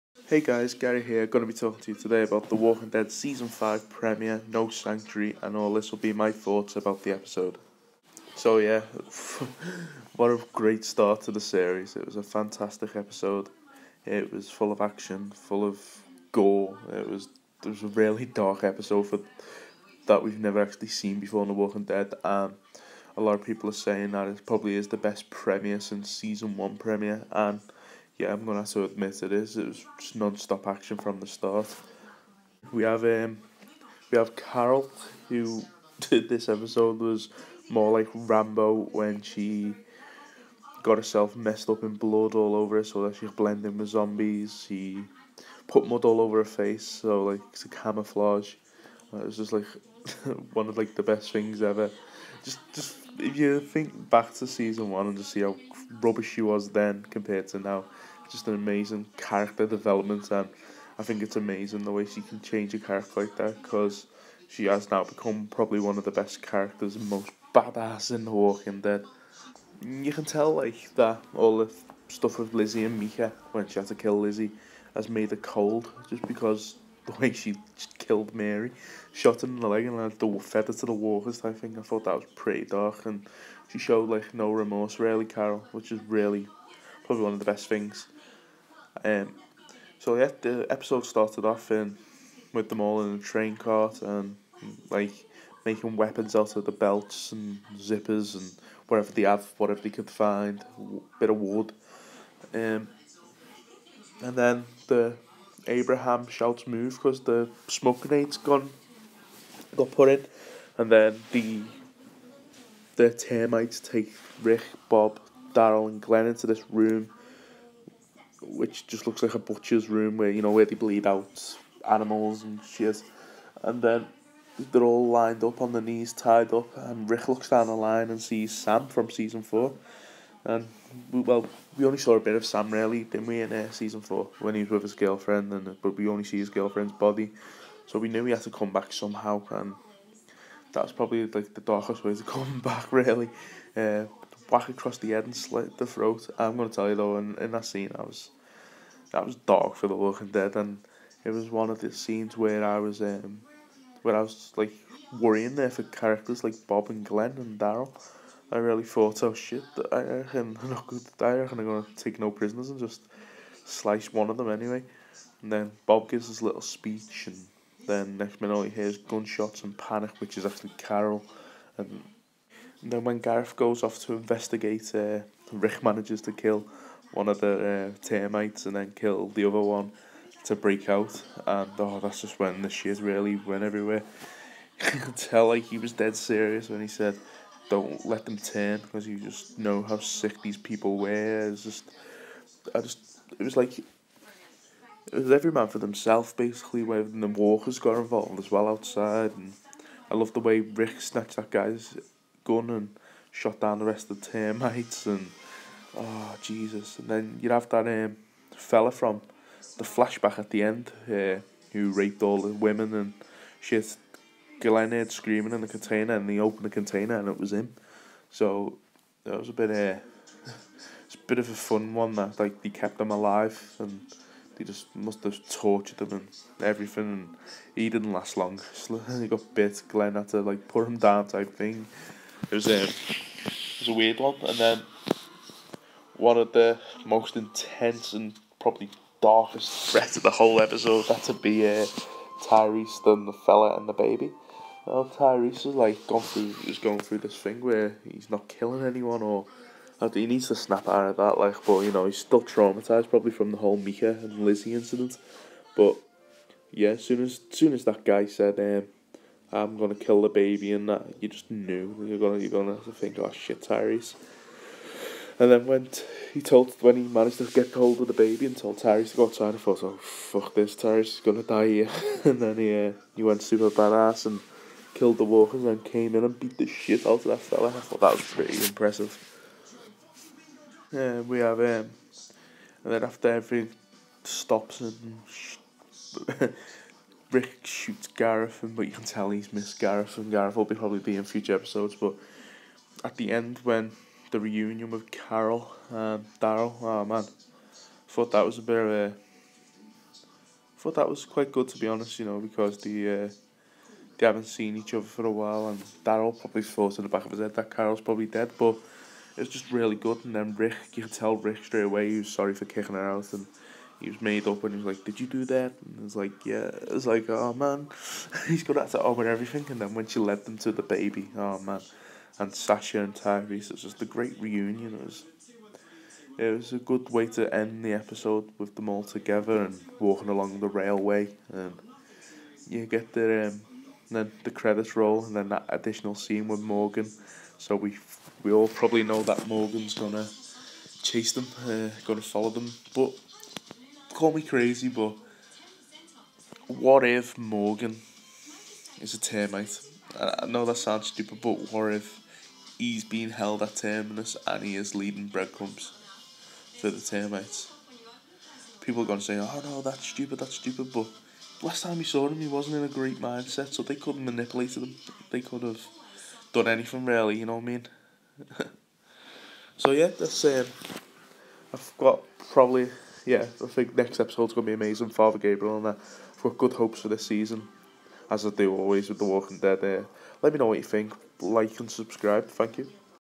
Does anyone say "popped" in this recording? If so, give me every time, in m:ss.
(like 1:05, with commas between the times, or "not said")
not said.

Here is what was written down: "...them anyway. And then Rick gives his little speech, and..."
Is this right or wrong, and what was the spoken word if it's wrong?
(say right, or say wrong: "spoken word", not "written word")
wrong: "Bob", not "Rick".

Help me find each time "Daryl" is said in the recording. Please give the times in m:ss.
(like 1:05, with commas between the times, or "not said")
1:55, 2:37, 4:56, 5:06.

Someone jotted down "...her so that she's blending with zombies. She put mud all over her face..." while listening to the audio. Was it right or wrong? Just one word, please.
right.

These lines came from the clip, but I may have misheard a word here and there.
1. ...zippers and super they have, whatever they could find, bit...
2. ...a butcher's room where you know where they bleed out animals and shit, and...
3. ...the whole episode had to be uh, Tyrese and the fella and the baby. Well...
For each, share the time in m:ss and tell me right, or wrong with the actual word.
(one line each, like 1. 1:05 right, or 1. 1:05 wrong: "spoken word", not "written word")
1. 1:37 wrong: "whatever", not "super"
2. 1:59 right
3. 4:00 right.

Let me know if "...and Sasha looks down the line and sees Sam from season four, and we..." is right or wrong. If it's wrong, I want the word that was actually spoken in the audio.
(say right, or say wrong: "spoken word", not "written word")
wrong: "Rick", not "Sasha".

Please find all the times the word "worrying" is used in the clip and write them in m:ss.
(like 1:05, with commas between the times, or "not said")
2:35.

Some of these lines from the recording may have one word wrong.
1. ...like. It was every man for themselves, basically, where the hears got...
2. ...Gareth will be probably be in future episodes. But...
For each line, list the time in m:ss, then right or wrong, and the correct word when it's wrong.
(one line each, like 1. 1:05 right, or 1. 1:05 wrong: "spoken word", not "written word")
1. 3:13 wrong: "walkers", not "hears"
2. 4:50 right.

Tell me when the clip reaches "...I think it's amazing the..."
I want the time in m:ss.
1:00.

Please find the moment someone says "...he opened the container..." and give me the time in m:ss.
3:36.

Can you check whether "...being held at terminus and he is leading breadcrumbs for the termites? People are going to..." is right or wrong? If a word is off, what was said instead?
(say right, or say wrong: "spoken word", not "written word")
right.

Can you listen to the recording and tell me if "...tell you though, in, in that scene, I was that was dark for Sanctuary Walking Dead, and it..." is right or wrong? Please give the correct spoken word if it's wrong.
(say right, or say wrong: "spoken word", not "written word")
wrong: "The", not "Sanctuary".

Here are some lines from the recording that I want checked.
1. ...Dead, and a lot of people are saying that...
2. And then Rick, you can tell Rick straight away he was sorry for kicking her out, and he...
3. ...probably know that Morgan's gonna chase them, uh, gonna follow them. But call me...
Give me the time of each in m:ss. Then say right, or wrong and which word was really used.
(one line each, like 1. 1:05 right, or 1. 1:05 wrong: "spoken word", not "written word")
1. 0:21 right
2. 5:10 right
3. 5:38 right.